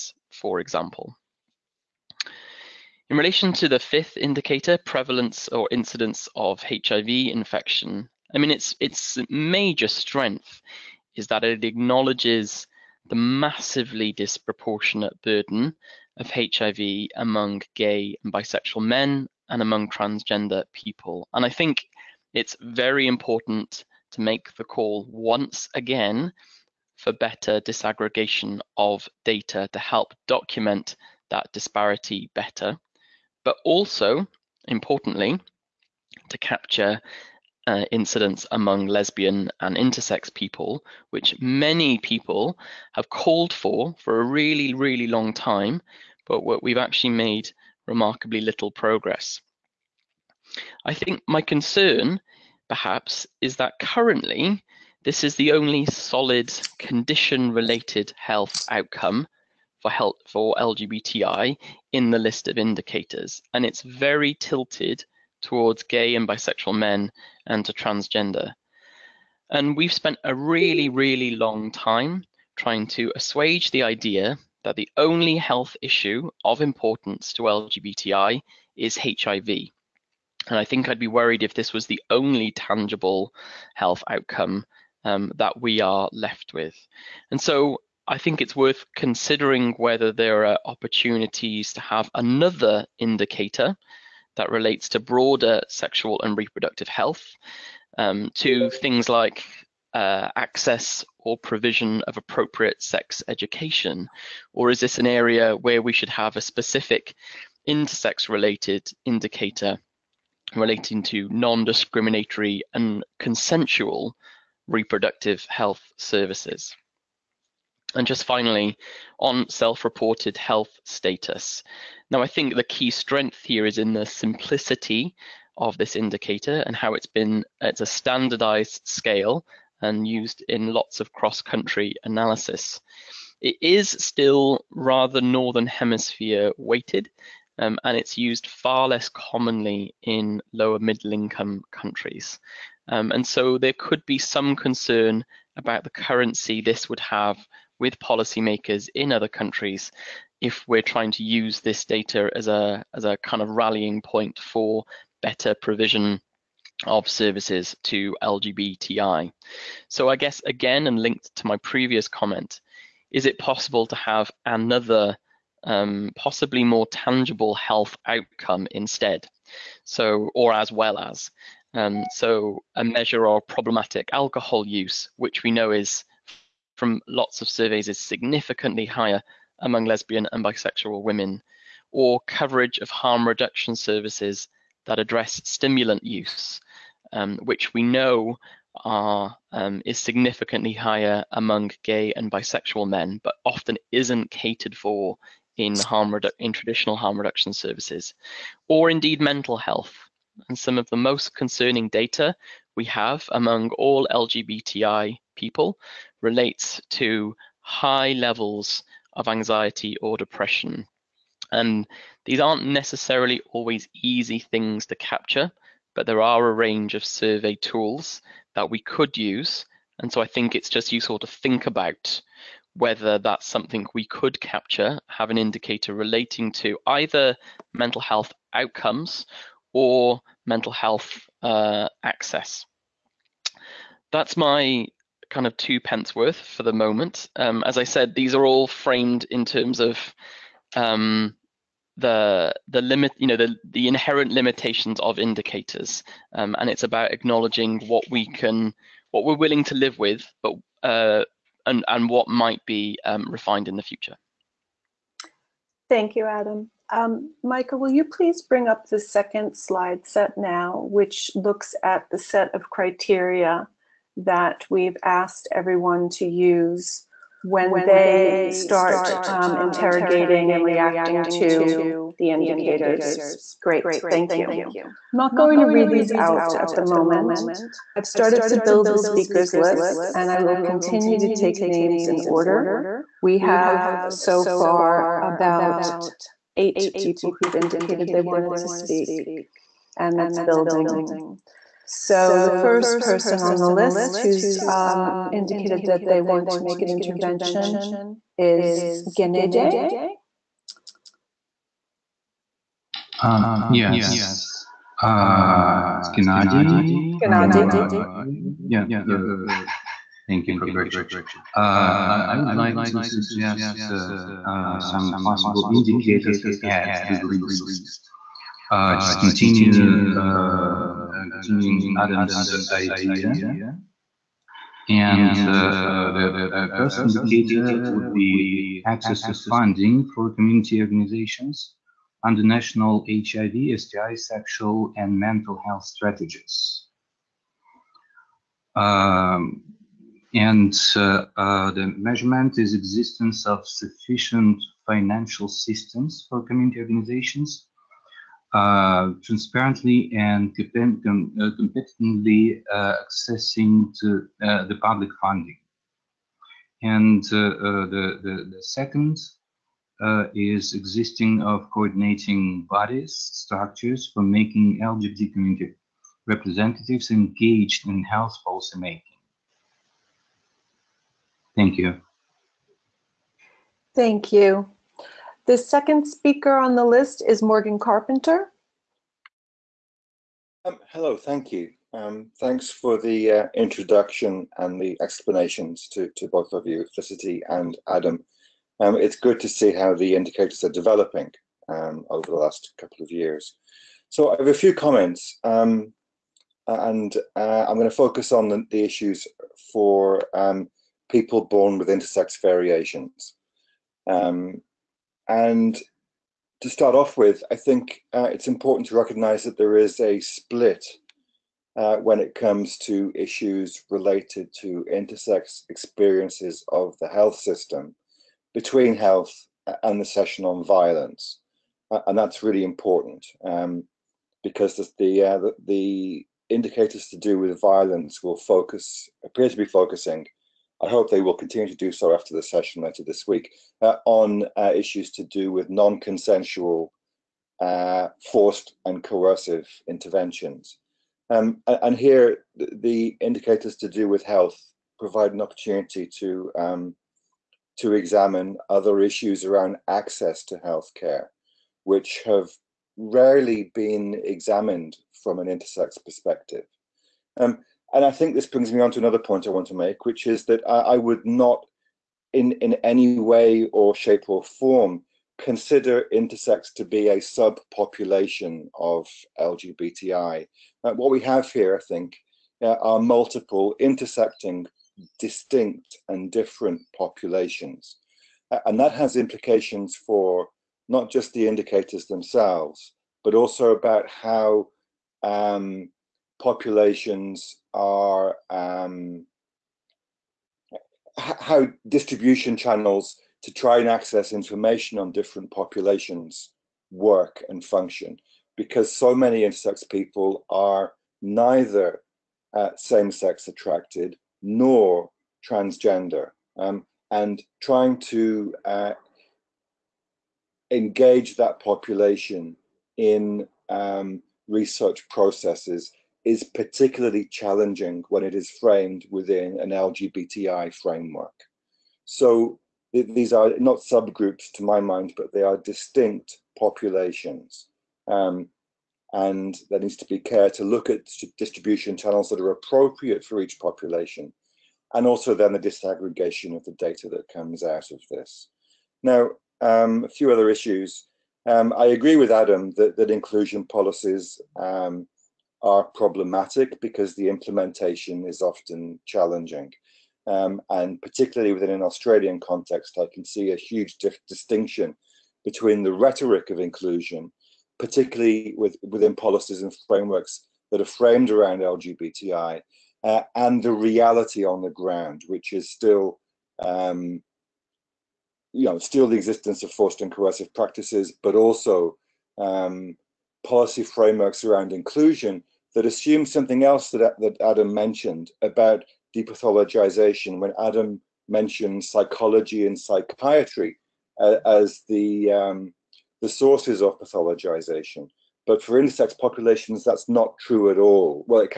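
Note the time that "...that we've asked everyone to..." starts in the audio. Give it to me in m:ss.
4:24.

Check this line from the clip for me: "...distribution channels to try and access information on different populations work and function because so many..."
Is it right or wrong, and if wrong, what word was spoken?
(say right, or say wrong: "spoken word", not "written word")
right.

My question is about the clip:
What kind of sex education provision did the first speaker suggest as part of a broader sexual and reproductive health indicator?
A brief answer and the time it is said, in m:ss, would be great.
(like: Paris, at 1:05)
appropriate sex education, at 1:42.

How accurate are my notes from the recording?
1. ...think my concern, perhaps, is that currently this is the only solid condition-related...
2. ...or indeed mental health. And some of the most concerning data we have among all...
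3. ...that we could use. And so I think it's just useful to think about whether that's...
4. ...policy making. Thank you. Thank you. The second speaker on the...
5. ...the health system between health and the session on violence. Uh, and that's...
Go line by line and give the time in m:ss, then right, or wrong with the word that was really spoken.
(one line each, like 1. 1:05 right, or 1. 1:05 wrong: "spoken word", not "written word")
1. 0:50 right
2. 3:18 right
3. 3:38 right
4. 6:08 right
5. 6:56 right.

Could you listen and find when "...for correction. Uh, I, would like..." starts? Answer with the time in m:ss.
5:10.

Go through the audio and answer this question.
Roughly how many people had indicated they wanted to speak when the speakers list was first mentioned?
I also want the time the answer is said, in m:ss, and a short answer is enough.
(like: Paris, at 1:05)
8, at 4:46.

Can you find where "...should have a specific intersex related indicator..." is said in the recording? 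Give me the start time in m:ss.
1:45.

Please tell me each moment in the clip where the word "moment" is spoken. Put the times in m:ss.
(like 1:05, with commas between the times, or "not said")
3:56, 4:36.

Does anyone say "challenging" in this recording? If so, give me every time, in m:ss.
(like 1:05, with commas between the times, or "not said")
8:37, 9:09.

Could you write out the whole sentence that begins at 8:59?
Now, um, a few other issues.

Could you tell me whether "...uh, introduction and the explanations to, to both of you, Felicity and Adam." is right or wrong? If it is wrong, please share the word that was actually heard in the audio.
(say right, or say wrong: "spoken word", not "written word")
right.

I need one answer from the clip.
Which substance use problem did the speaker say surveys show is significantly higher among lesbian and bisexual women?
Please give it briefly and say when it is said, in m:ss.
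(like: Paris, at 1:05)
problematic alcohol use, at 2:53.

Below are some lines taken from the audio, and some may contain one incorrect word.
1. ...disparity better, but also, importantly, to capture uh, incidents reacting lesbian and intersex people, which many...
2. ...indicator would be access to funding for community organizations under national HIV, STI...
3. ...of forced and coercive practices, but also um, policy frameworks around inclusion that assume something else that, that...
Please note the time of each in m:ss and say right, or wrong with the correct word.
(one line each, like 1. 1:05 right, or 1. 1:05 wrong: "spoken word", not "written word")
1. 0:31 wrong: "among", not "reacting"
2. 5:27 right
3. 9:29 right.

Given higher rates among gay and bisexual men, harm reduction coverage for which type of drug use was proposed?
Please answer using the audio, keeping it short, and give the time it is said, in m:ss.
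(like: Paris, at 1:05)
stimulant use, at 3:05.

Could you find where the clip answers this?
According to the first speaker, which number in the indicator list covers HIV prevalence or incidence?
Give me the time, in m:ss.
0:03.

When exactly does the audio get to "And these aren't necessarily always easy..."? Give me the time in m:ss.
3:31.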